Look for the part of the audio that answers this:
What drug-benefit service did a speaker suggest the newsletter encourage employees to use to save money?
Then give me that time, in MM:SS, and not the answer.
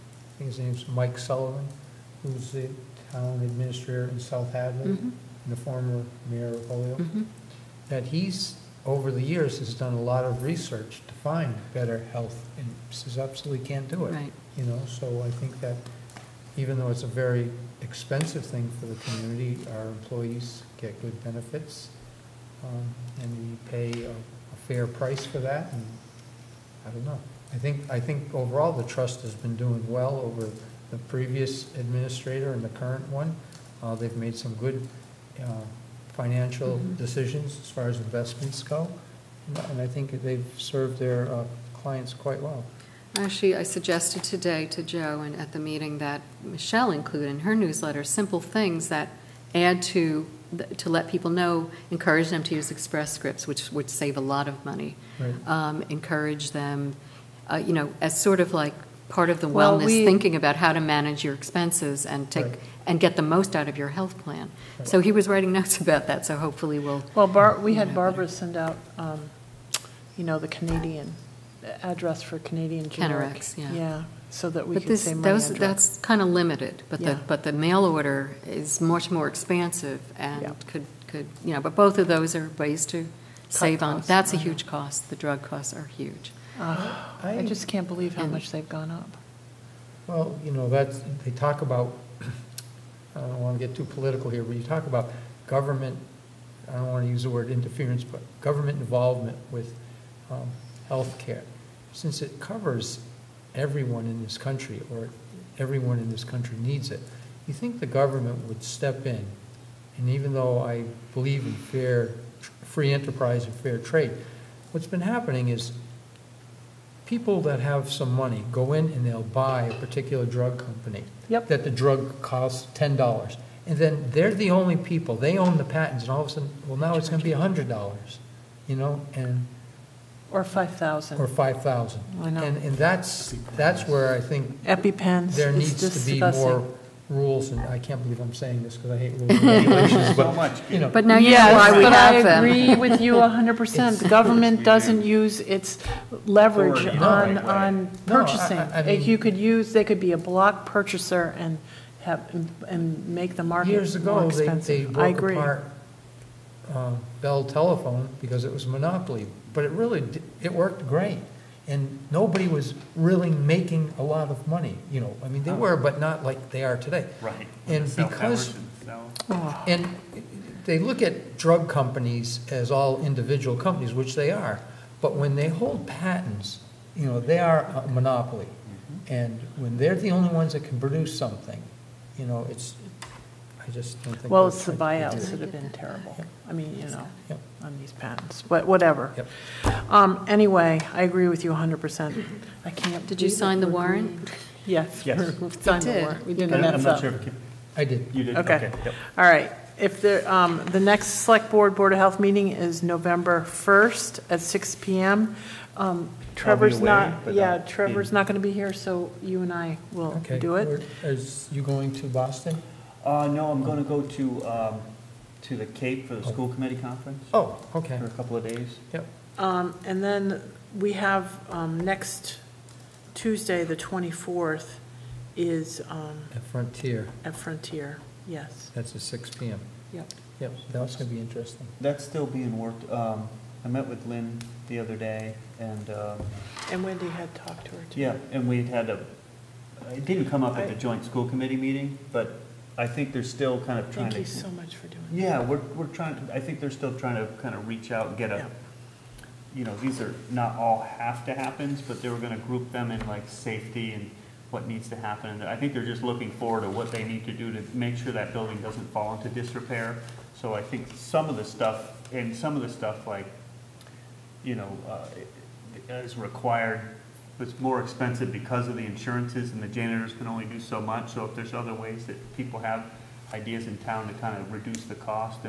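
00:52.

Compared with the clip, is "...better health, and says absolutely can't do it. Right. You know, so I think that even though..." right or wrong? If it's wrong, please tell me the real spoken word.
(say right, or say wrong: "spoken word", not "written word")
right.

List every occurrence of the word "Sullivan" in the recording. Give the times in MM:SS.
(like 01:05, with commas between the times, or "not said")
00:01.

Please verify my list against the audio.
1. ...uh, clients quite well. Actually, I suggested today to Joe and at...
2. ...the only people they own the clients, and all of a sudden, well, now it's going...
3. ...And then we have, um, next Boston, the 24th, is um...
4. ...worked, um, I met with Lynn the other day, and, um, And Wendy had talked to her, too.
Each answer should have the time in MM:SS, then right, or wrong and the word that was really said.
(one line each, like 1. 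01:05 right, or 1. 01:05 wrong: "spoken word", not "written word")
1. 00:41 right
2. 02:04 wrong: "patents", not "clients"
3. 03:39 wrong: "Tuesday", not "Boston"
4. 03:52 right.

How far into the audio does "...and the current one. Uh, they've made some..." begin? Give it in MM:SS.
00:32.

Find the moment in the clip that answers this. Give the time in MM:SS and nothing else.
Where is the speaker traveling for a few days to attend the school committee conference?
03:35.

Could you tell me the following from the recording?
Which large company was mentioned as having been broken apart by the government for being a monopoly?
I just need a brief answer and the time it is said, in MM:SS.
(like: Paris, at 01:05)
Bell Telephone, at 02:37.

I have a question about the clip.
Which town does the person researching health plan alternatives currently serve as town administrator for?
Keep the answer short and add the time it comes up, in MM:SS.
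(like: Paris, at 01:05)
South Hadley, at 00:04.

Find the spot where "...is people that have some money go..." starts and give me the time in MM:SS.
01:55.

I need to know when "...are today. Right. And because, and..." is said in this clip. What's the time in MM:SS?
02:46.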